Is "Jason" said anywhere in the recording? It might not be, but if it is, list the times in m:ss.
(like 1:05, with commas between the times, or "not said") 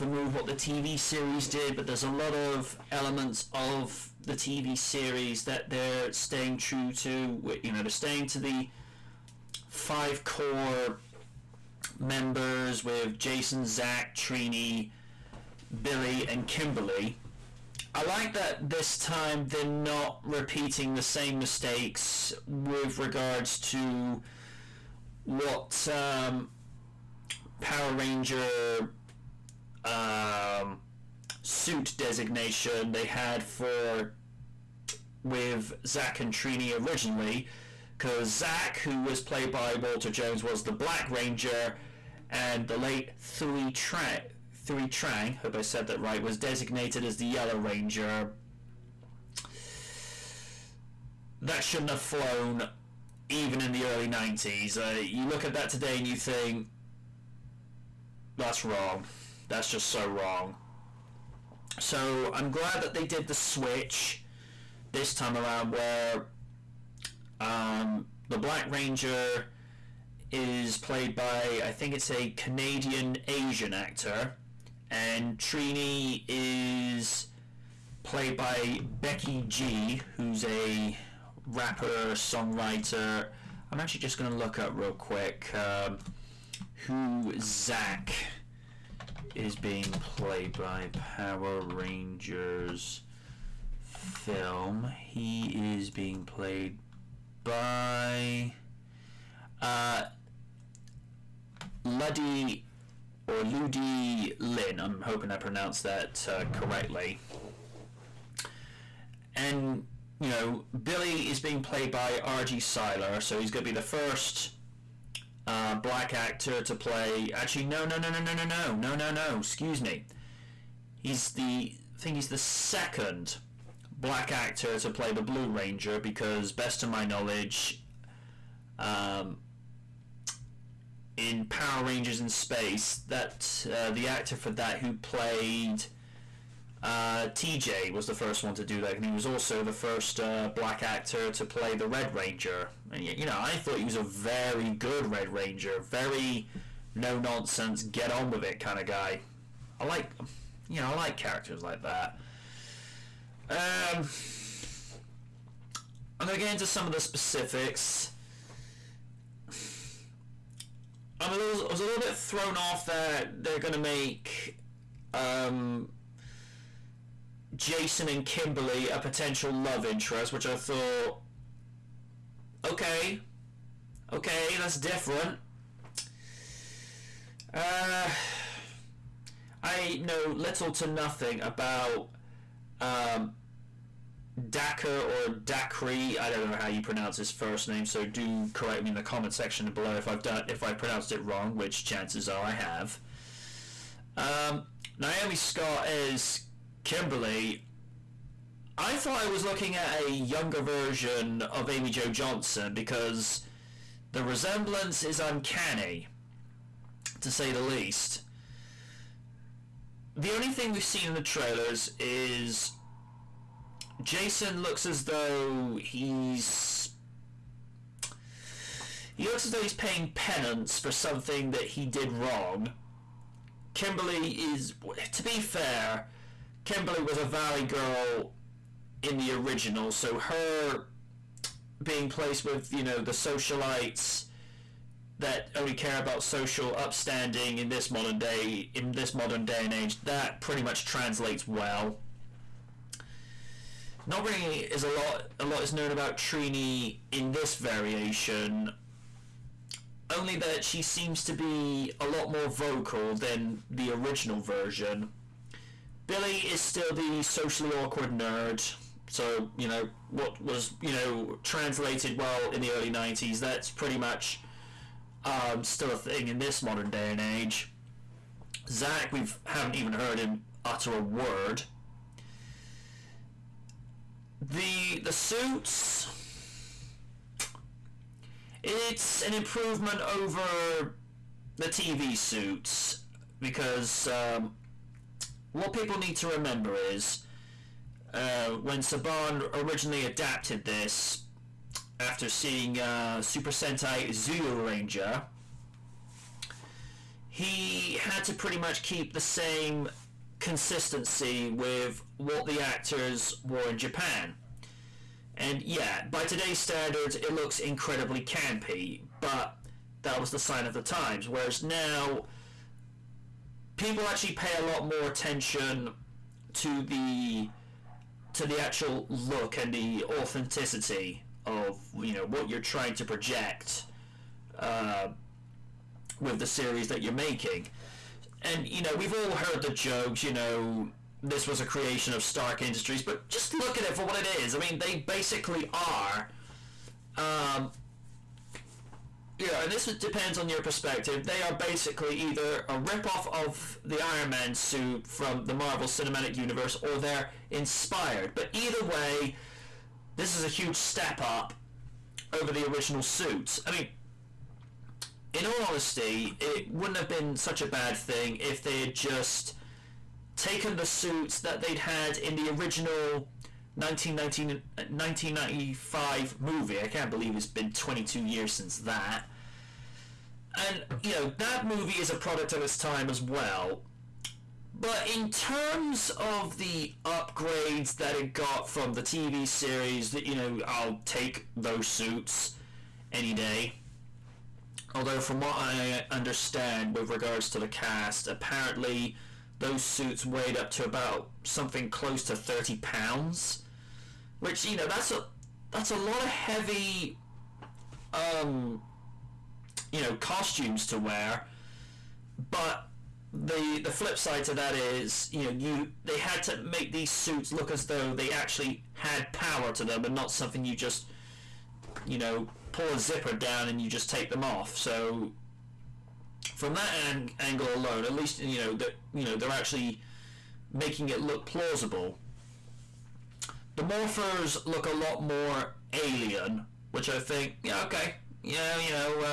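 0:13, 2:47, 3:34.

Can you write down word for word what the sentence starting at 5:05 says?
And yeah, by today's standards, it looks incredibly campy, but that was the sign of the times.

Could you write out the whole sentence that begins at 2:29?
I like, you know, I like characters like that.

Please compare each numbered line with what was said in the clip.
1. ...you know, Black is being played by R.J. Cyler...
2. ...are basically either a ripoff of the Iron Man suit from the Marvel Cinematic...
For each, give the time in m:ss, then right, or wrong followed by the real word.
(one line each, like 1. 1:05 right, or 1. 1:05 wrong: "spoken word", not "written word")
1. 1:50 wrong: "Billy", not "Black"
2. 5:41 right.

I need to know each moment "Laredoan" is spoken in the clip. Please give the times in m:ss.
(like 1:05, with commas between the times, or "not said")
not said.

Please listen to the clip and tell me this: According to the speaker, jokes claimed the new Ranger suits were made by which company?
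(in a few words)
Stark Industries.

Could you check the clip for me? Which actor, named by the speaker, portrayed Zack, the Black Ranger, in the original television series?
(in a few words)
Walter Jones.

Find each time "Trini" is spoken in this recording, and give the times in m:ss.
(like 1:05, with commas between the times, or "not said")
0:14, 0:36, 1:15, 4:06.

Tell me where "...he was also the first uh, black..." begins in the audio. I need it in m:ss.
2:19.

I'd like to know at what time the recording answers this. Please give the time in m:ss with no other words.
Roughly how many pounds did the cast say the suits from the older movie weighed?
6:32.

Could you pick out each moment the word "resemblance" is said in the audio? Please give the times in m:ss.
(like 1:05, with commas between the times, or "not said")
3:24.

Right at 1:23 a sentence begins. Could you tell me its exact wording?
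I'm actually just going to look up real quick um, who Zack is being played by Power Rangers film.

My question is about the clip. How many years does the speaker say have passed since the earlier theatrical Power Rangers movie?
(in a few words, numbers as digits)
22.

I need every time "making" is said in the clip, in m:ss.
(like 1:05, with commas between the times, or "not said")
5:27, 7:00.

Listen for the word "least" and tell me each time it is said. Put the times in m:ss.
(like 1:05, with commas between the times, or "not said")
3:27, 6:58.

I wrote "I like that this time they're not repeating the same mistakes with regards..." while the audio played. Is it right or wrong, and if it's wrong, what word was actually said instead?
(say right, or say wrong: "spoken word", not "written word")
right.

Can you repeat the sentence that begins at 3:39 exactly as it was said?
He looks as though he's paying penance for something that he did wrong.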